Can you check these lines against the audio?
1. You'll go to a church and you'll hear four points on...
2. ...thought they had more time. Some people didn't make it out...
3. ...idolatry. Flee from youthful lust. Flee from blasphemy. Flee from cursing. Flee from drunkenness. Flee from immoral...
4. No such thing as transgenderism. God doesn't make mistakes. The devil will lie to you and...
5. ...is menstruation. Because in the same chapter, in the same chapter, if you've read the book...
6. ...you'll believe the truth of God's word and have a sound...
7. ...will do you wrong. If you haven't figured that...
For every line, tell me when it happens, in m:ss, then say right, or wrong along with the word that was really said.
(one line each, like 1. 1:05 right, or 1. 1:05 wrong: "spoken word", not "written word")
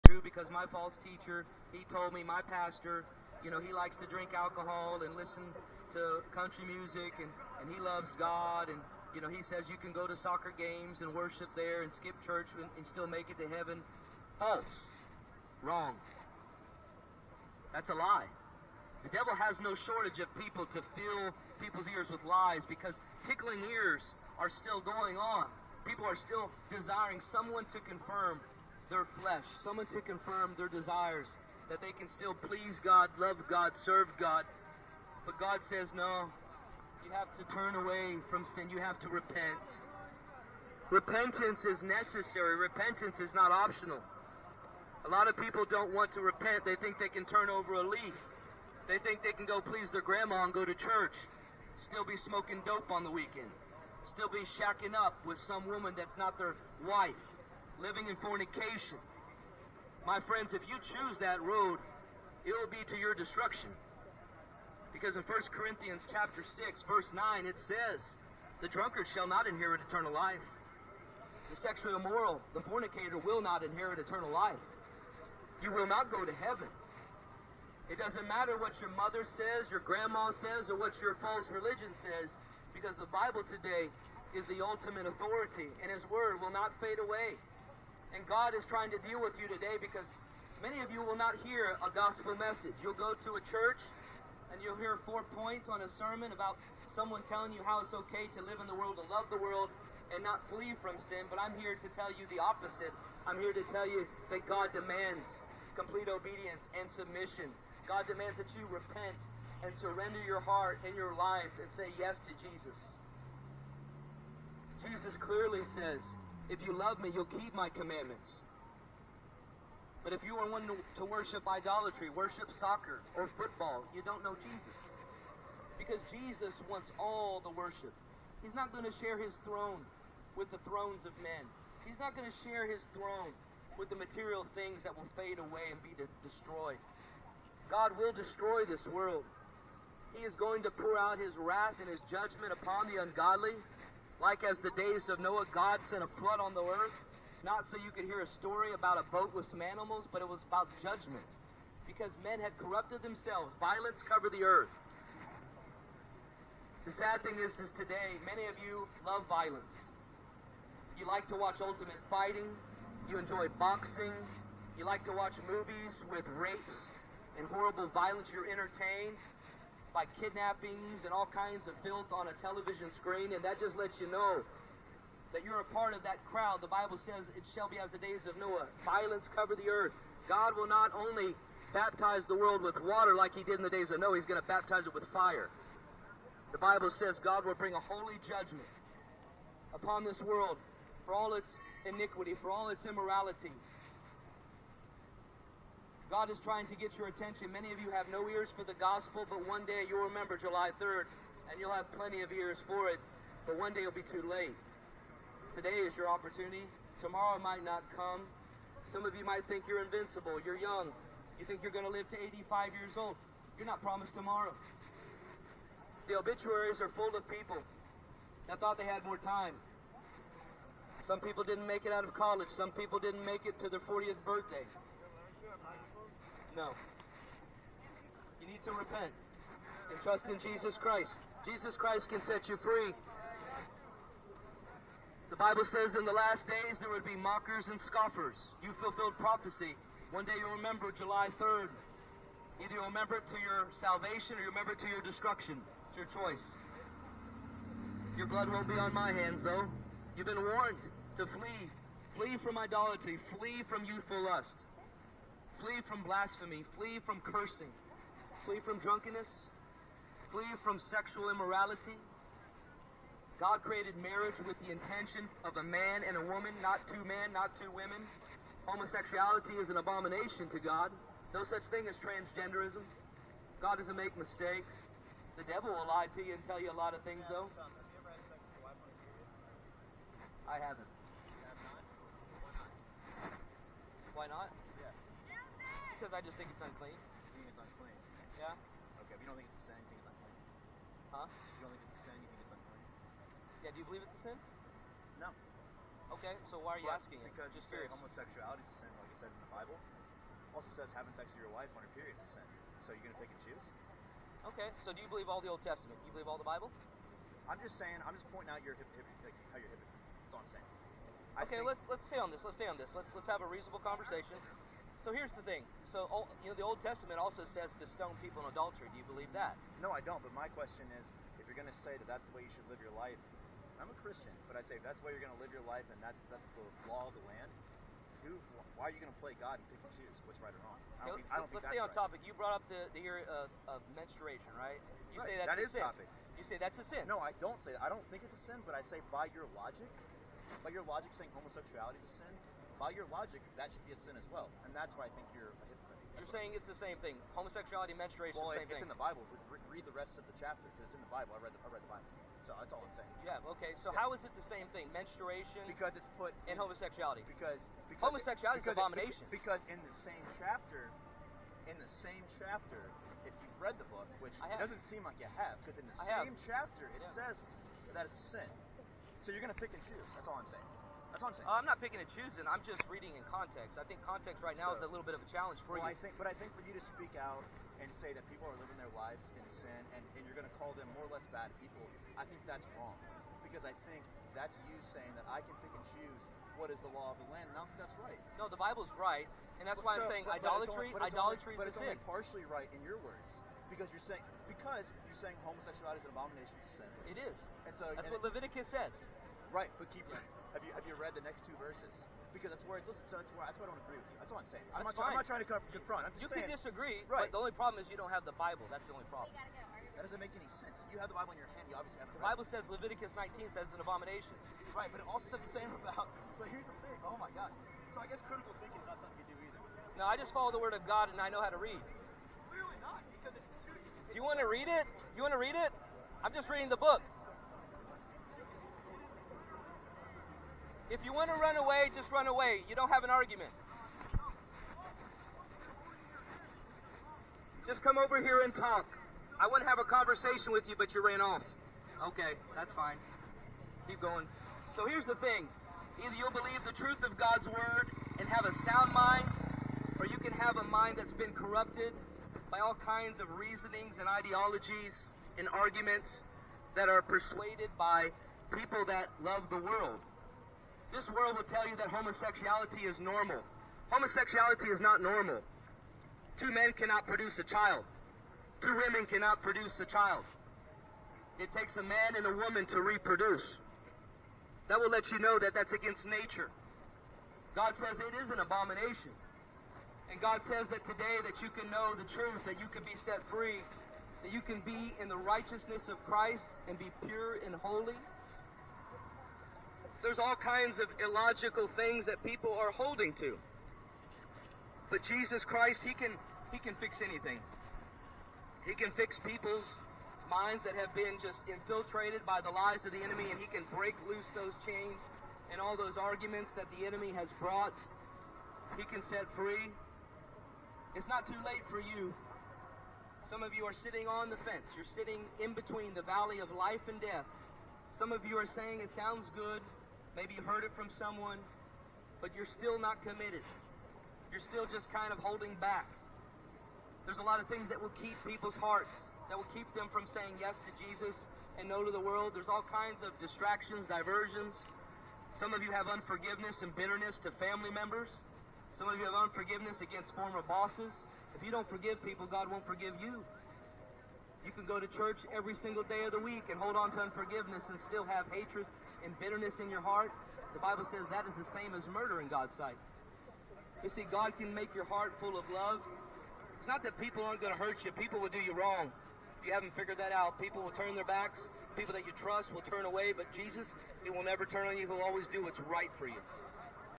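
1. 1:32 right
2. 3:38 right
3. 4:12 wrong: "sexual", not "immoral"
4. 4:31 right
5. 5:58 wrong: "abomination", not "menstruation"
6. 7:26 right
7. 9:18 right.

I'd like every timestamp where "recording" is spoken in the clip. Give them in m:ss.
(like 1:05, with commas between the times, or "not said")
not said.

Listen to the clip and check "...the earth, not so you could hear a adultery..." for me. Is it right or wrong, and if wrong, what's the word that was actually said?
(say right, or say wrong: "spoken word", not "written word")
wrong: "story", not "adultery".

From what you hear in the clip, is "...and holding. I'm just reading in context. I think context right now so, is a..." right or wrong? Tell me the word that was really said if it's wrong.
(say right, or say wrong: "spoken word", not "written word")
wrong: "choosing", not "holding".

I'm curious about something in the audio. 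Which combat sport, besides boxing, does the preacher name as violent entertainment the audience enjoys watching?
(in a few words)
ultimate fighting.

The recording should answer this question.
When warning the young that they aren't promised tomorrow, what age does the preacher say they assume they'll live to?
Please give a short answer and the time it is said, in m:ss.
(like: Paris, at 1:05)
85, at 3:32.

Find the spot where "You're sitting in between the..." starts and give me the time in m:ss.
8:34.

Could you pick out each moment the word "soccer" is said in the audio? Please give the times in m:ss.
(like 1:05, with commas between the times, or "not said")
0:10, 2:02.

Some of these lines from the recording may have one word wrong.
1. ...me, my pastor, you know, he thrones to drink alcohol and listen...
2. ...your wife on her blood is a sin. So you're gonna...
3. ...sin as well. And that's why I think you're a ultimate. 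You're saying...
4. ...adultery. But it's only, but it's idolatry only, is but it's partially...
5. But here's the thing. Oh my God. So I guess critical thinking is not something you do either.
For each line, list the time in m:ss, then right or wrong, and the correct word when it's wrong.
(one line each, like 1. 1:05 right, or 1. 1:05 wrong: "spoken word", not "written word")
1. 0:02 wrong: "likes", not "thrones"
2. 5:01 wrong: "period", not "blood"
3. 5:44 wrong: "hypocrite", not "ultimate"
4. 6:30 wrong: "idolatry", not "adultery"
5. 6:56 right.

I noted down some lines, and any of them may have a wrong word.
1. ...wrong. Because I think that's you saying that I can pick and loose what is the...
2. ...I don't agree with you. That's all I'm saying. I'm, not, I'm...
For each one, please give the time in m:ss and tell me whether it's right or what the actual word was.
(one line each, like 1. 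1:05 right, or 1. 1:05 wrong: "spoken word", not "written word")
1. 6:22 wrong: "choose", not "loose"
2. 6:43 right.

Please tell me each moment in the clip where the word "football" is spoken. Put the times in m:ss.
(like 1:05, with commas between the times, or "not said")
2:03.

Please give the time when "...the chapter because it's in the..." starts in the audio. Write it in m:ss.
5:50.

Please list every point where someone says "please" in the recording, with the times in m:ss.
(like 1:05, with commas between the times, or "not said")
0:32, 0:49.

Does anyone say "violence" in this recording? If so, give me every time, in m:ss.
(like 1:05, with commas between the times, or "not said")
2:33, 2:39, 2:47, 2:58.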